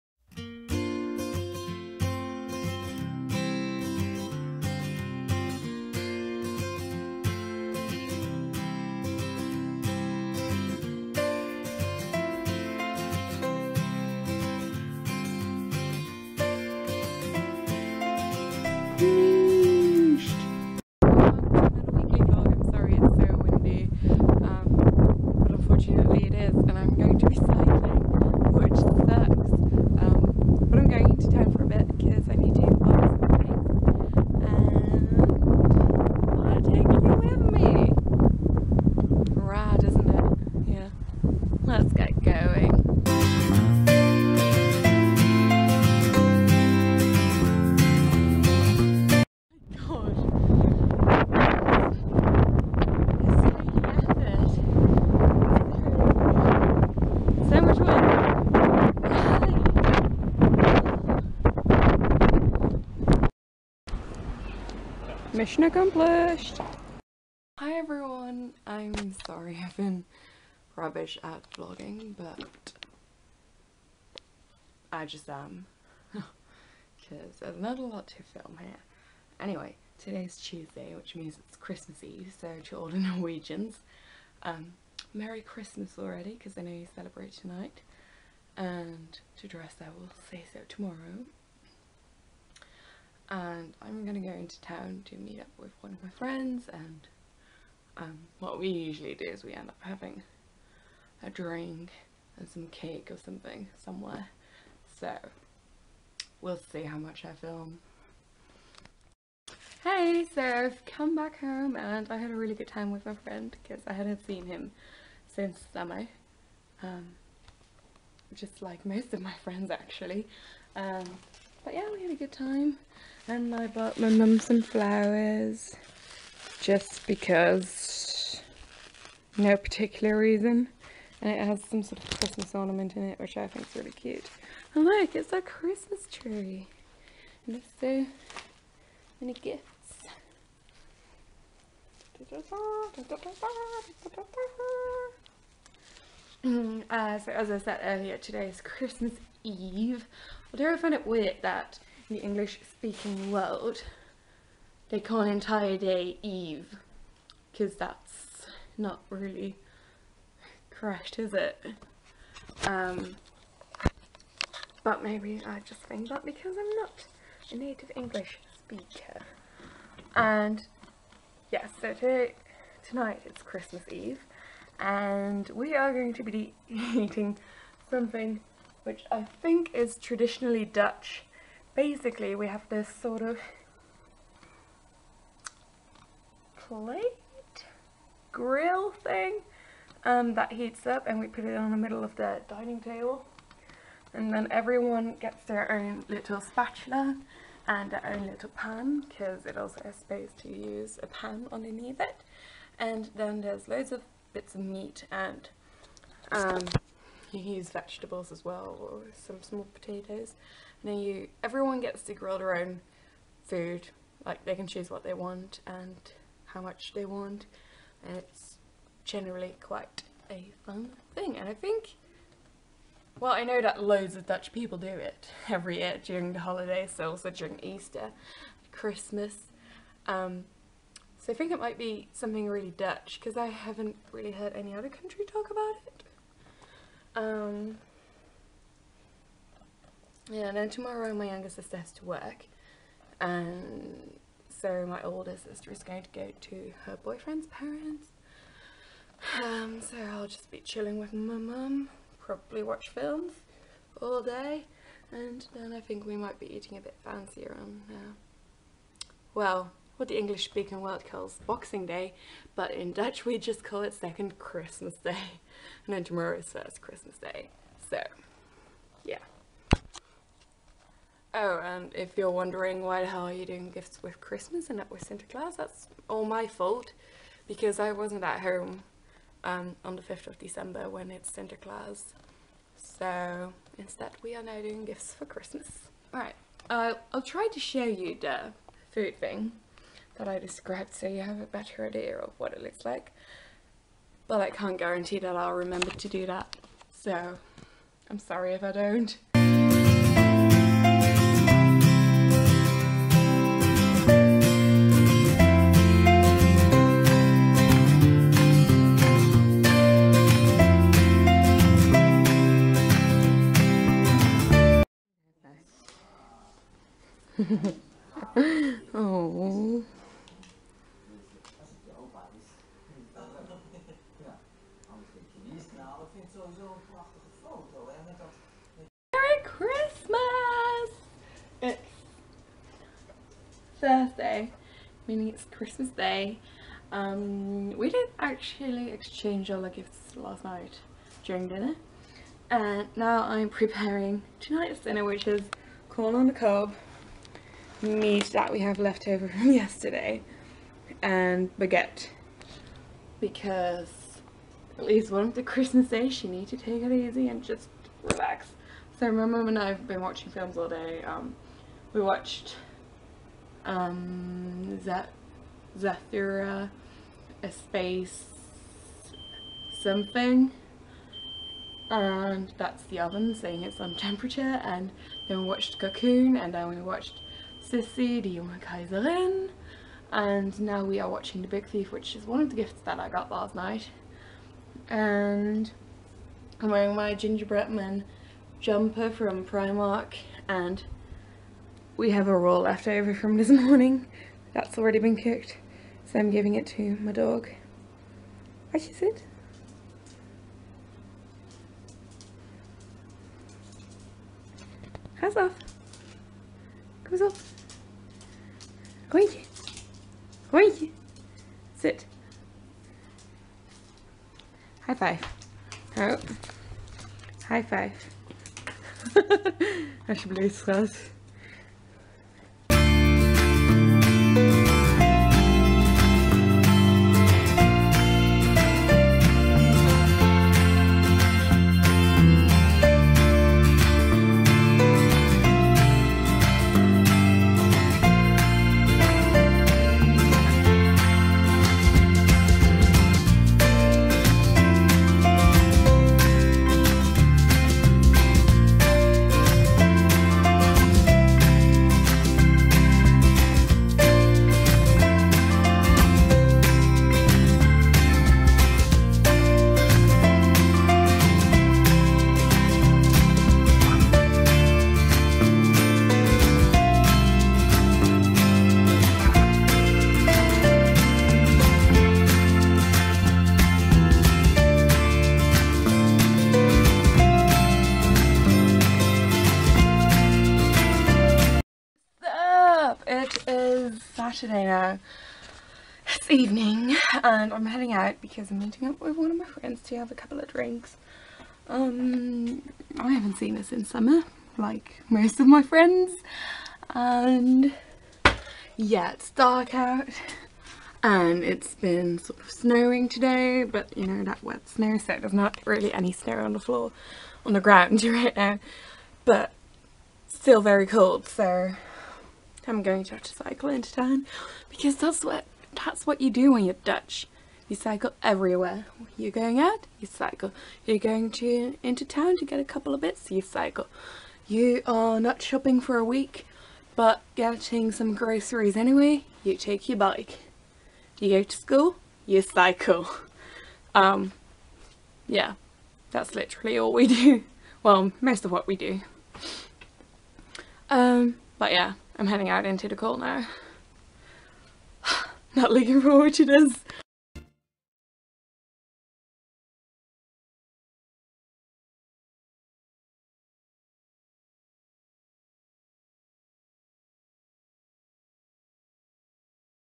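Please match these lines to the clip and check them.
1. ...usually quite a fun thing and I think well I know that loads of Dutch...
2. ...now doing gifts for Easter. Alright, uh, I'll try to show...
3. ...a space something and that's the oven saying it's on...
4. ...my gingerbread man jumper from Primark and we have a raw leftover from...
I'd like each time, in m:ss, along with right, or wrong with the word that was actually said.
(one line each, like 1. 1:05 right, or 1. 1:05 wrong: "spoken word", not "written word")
1. 3:39 wrong: "generally", not "usually"
2. 4:44 wrong: "Christmas", not "Easter"
3. 6:07 right
4. 6:26 right.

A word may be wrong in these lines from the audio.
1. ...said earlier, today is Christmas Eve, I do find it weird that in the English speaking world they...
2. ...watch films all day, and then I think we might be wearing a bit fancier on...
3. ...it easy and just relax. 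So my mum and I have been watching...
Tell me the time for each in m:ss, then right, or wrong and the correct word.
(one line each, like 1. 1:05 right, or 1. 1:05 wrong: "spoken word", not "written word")
1. 2:27 right
2. 4:12 wrong: "eating", not "wearing"
3. 5:56 right.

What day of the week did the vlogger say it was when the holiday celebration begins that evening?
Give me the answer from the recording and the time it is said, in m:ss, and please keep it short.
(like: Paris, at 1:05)
Tuesday, at 1:20.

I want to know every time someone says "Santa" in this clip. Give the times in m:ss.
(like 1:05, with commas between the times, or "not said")
4:35, 4:41.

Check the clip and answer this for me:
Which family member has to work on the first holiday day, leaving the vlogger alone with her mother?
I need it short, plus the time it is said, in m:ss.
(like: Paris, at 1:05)
younger sister, at 4:01.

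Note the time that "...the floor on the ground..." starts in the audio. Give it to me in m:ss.
8:26.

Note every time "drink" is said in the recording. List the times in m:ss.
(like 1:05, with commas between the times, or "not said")
1:41, 8:10.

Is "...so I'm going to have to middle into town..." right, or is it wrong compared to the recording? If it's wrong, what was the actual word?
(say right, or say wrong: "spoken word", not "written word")
wrong: "cycle", not "middle".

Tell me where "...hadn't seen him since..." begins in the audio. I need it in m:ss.
1:53.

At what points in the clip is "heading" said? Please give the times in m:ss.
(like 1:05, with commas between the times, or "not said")
8:07, 9:02.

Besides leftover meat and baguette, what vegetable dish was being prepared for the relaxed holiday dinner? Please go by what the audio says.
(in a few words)
corn on the cob.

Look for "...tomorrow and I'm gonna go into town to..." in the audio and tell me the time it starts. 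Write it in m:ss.
1:30.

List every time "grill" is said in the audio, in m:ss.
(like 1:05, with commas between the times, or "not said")
3:08, 3:32.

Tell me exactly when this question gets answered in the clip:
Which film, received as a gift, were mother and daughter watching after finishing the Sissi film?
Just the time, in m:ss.
6:21.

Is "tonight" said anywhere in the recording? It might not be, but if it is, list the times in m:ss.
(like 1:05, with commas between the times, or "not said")
1:27, 2:52, 5:44.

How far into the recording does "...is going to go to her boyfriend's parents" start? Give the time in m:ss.
4:05.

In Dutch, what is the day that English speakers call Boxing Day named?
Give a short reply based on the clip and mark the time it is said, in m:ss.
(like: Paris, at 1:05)
second Christmas Day, at 4:23.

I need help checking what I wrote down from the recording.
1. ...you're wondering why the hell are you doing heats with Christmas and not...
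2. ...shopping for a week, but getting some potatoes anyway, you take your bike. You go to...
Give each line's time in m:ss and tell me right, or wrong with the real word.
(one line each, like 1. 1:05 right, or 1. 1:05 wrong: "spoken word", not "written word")
1. 4:32 wrong: "gifts", not "heats"
2. 8:45 wrong: "groceries", not "potatoes".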